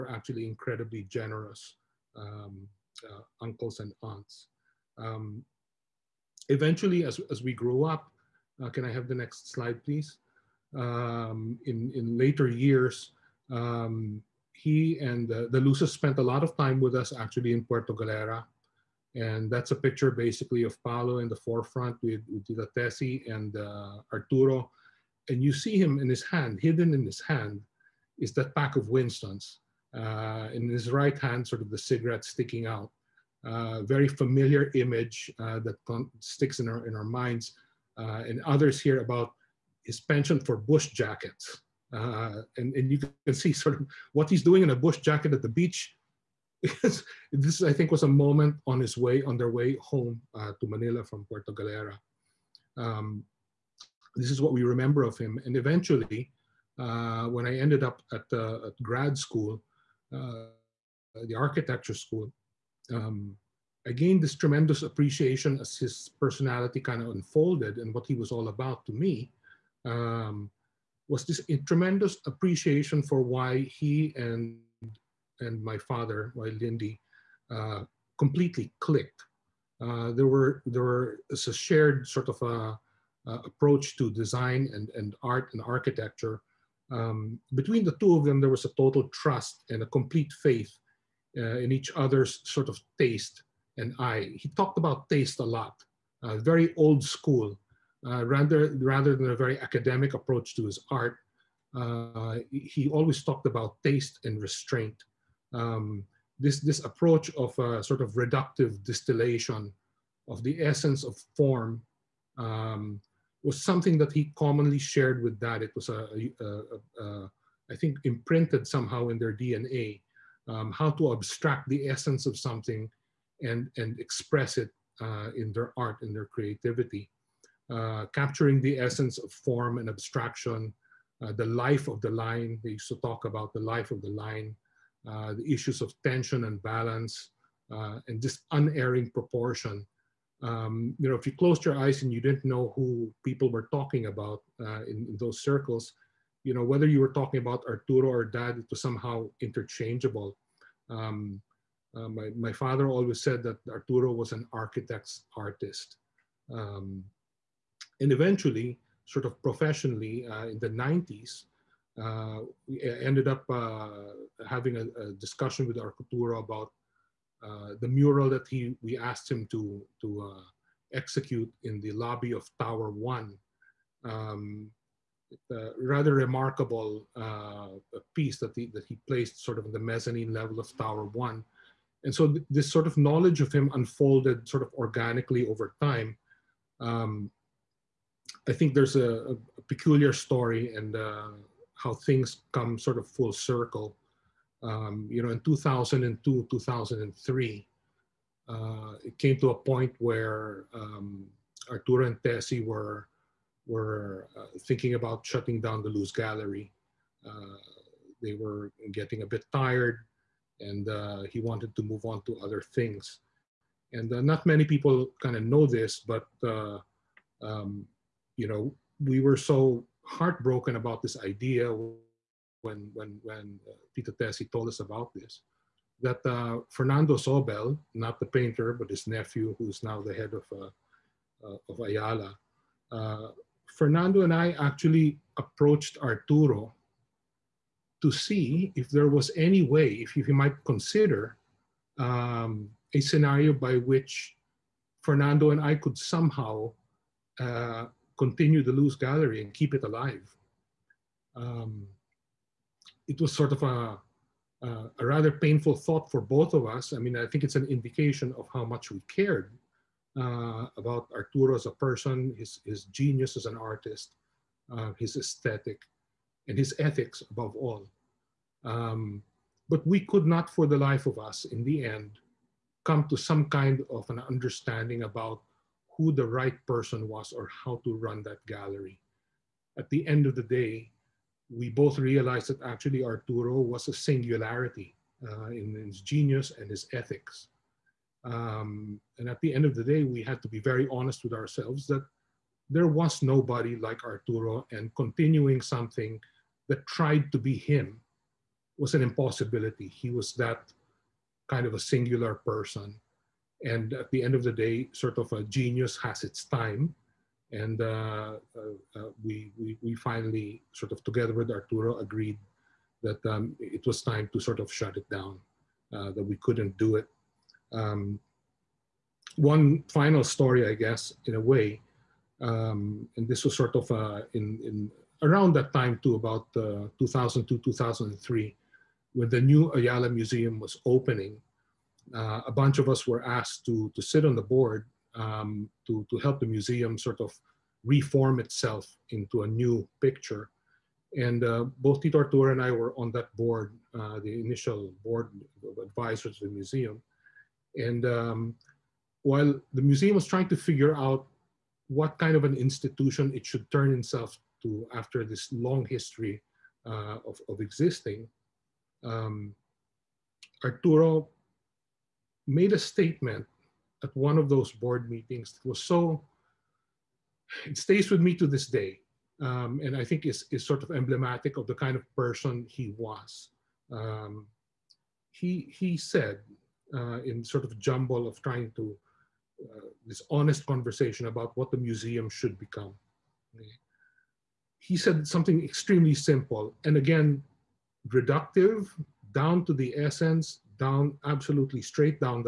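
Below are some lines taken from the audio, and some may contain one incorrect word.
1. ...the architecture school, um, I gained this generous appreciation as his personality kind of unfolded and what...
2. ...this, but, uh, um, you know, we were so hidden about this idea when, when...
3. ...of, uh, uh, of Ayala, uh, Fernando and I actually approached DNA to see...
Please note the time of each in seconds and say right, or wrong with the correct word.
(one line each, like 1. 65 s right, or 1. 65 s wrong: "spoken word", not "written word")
1. 61 s wrong: "tremendous", not "generous"
2. 215 s wrong: "heartbroken", not "hidden"
3. 230 s wrong: "Arturo", not "DNA".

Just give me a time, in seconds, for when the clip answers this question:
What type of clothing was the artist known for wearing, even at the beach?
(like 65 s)
40 s.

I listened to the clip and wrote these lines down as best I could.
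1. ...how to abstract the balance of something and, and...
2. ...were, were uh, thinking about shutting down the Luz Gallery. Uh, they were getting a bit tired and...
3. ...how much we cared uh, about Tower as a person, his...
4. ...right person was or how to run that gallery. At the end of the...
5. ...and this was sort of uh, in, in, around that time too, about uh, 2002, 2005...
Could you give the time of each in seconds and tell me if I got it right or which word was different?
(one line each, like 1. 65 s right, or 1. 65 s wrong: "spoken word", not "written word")
1. 120 s wrong: "essence", not "balance"
2. 202 s right
3. 258 s wrong: "Arturo", not "Tower"
4. 276 s right
5. 323 s wrong: "2003", not "2005".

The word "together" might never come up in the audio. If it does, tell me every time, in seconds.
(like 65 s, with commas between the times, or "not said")
311 s.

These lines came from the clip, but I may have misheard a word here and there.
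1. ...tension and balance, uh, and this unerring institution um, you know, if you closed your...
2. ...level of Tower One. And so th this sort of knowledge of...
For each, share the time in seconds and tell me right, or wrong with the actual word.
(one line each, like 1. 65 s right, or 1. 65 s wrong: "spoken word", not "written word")
1. 136 s wrong: "proportion", not "institution"
2. 180 s right.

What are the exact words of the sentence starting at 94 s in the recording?
He talked about taste a lot, uh, very old school, uh, rather, rather than a very academic approach to his art.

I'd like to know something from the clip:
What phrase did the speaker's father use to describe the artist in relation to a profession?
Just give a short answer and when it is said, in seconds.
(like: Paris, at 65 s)
An architect's artist, at 154 s.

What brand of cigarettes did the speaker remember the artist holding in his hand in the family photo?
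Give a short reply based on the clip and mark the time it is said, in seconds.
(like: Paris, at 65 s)
Winstons, at 28 s.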